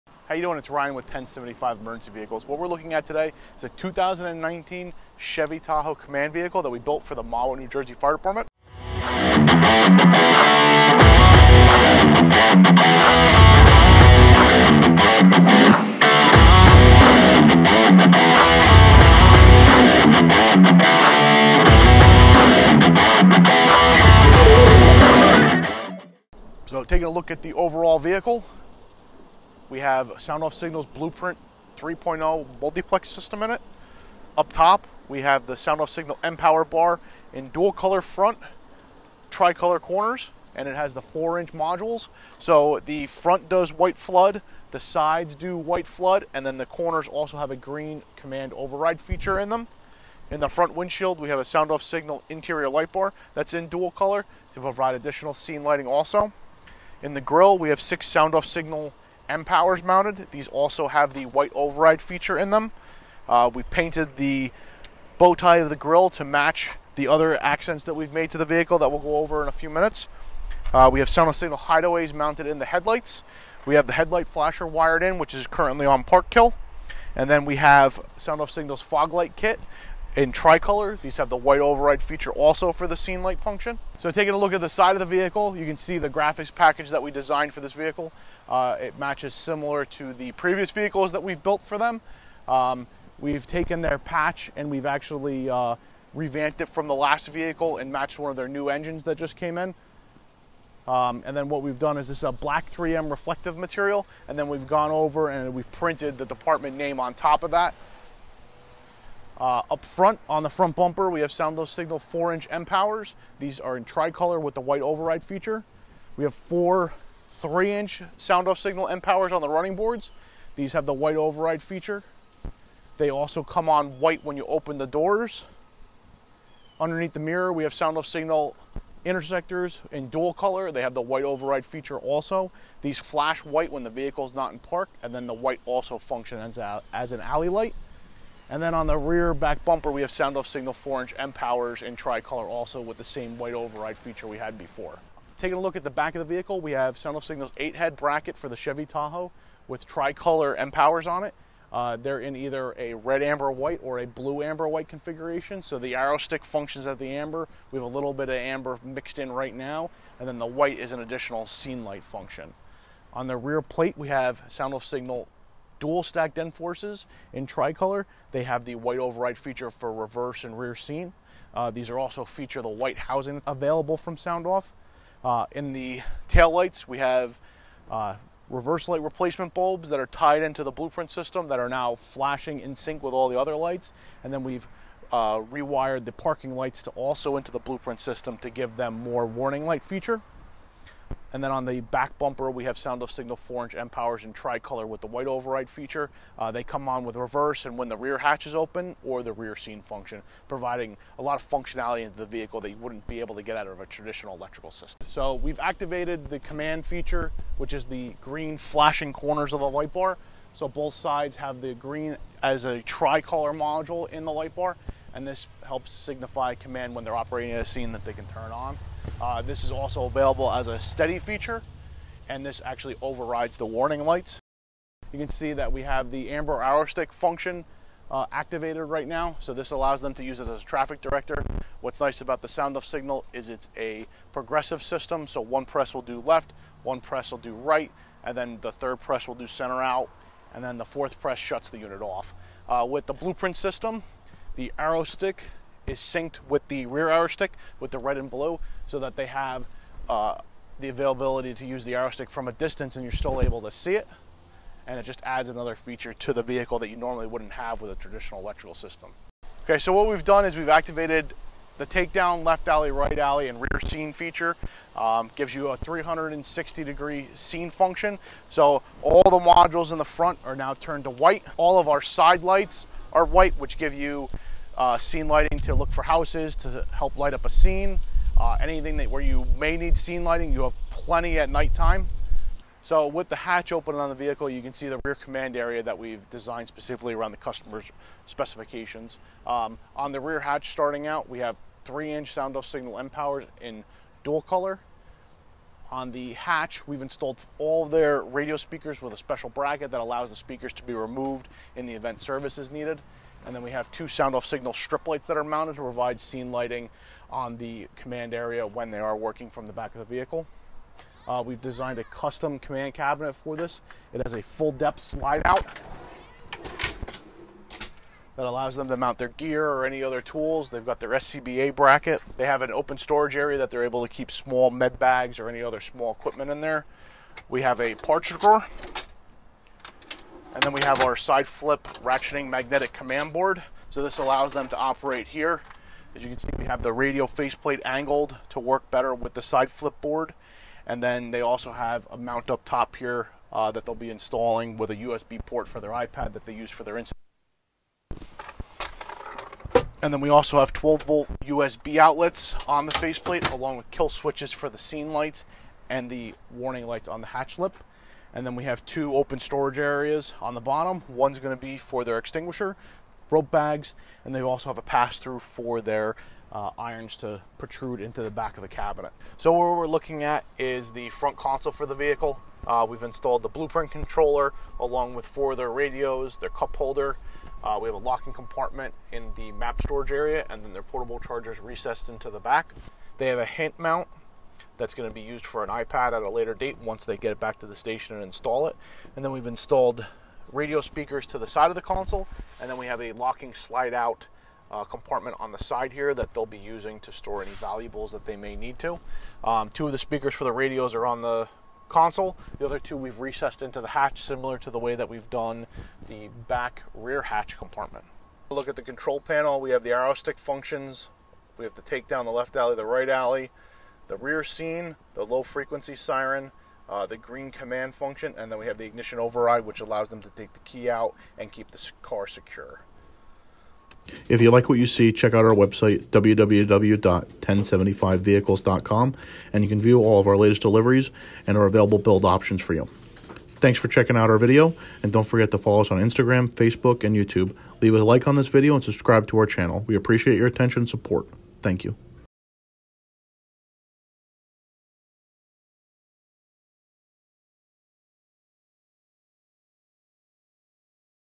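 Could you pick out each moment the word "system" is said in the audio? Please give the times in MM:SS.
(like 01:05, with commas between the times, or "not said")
00:33, 03:01, 03:07, 03:24, 03:54, 04:03, 04:18.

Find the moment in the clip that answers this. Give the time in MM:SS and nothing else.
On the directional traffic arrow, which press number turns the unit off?
04:00.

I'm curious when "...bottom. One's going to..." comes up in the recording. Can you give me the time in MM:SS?
06:00.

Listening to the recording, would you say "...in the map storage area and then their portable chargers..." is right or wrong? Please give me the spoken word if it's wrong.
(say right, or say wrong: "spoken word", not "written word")
right.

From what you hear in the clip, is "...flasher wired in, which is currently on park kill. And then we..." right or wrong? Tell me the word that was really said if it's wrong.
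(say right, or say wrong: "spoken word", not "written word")
right.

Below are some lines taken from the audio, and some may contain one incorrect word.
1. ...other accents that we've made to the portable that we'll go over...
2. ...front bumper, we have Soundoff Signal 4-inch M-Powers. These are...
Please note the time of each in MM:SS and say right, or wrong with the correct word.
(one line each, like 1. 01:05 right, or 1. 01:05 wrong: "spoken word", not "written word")
1. 01:07 wrong: "vehicle", not "portable"
2. 01:50 right.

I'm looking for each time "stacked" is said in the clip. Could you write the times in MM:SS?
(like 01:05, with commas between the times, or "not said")
02:46.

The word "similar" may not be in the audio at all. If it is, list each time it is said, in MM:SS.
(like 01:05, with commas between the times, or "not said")
01:29, 06:44.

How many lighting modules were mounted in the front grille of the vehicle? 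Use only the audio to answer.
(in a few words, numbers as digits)
6.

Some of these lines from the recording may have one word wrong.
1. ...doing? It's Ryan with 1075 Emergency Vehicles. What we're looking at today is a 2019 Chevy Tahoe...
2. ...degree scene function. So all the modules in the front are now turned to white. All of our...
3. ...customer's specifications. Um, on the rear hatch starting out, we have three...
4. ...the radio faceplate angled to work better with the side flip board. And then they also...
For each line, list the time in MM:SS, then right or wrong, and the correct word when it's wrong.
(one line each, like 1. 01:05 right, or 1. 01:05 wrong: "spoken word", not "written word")
1. 00:00 right
2. 04:26 right
3. 04:47 right
4. 05:36 right.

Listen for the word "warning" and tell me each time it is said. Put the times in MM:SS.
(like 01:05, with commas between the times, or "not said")
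03:09, 03:43, 05:56.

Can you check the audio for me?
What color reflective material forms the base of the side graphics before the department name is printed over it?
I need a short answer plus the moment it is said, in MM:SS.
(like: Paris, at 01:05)
Black, at 01:42.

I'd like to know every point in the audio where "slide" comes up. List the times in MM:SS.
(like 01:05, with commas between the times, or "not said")
05:14, 06:33.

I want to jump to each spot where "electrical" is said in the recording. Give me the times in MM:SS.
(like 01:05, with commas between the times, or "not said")
03:24, 04:18.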